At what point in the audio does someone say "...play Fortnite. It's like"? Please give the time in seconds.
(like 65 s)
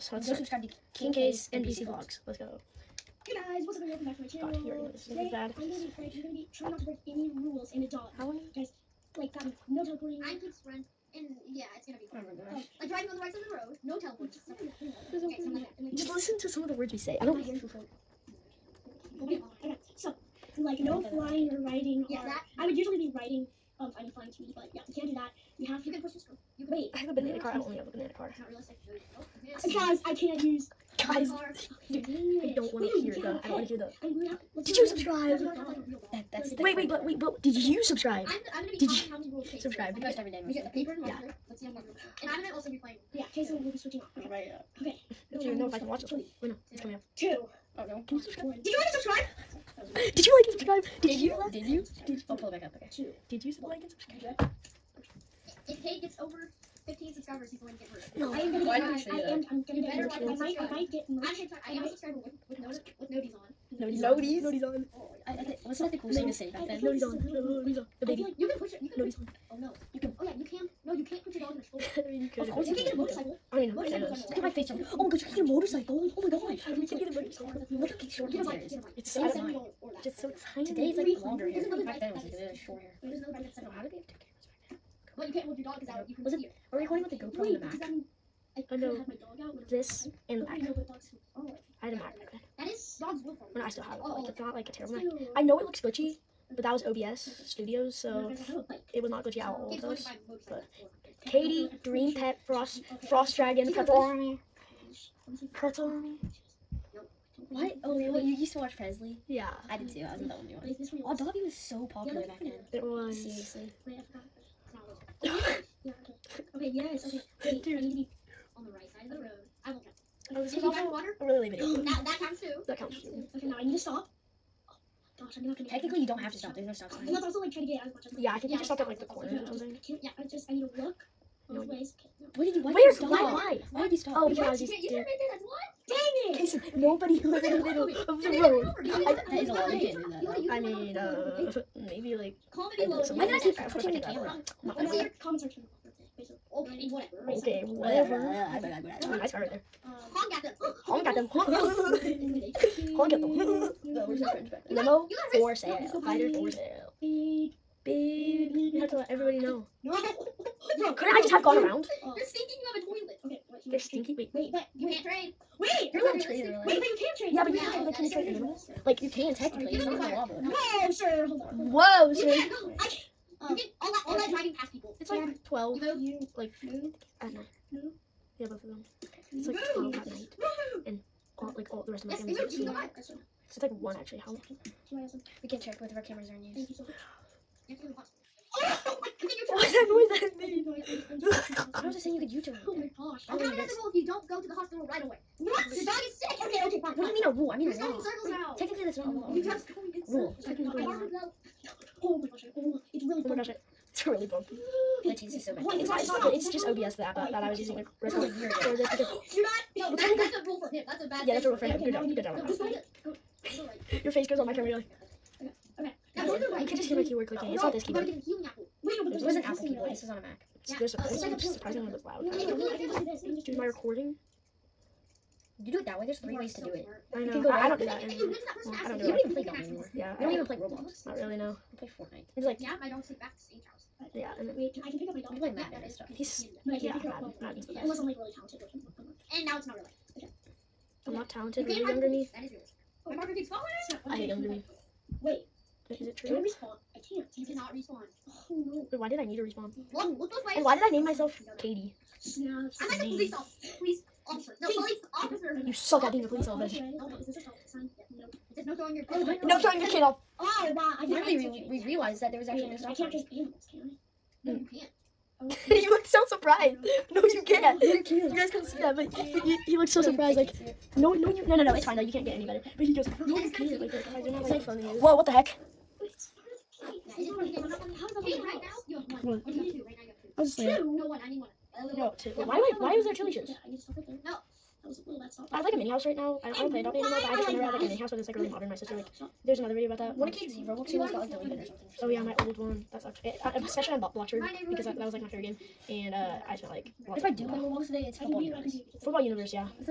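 231 s.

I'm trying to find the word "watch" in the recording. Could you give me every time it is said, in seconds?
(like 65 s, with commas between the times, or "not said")
45 s, 108 s.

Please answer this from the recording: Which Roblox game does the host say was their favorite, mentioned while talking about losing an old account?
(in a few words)
Bloxburg.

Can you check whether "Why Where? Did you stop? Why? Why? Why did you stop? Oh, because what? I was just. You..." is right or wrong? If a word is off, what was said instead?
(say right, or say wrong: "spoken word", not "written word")
right.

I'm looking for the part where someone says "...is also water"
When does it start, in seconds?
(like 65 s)
120 s.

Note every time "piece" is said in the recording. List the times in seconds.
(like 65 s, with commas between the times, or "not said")
not said.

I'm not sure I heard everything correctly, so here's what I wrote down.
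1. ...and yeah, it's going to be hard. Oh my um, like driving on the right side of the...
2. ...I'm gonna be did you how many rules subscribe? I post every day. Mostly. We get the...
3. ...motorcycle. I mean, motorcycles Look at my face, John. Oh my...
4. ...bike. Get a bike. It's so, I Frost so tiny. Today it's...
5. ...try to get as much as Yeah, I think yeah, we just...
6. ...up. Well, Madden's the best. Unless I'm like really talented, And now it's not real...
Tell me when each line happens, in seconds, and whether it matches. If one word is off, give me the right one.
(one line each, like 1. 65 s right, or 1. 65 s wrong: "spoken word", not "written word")
1. 11 s right
2. 38 s right
3. 72 s right
4. 78 s wrong: "Just", not "Frost"
5. 127 s right
6. 237 s right.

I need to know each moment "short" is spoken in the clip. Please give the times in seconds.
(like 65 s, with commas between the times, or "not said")
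17 s, 78 s, 82 s.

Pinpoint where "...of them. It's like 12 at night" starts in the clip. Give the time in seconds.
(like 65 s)
178 s.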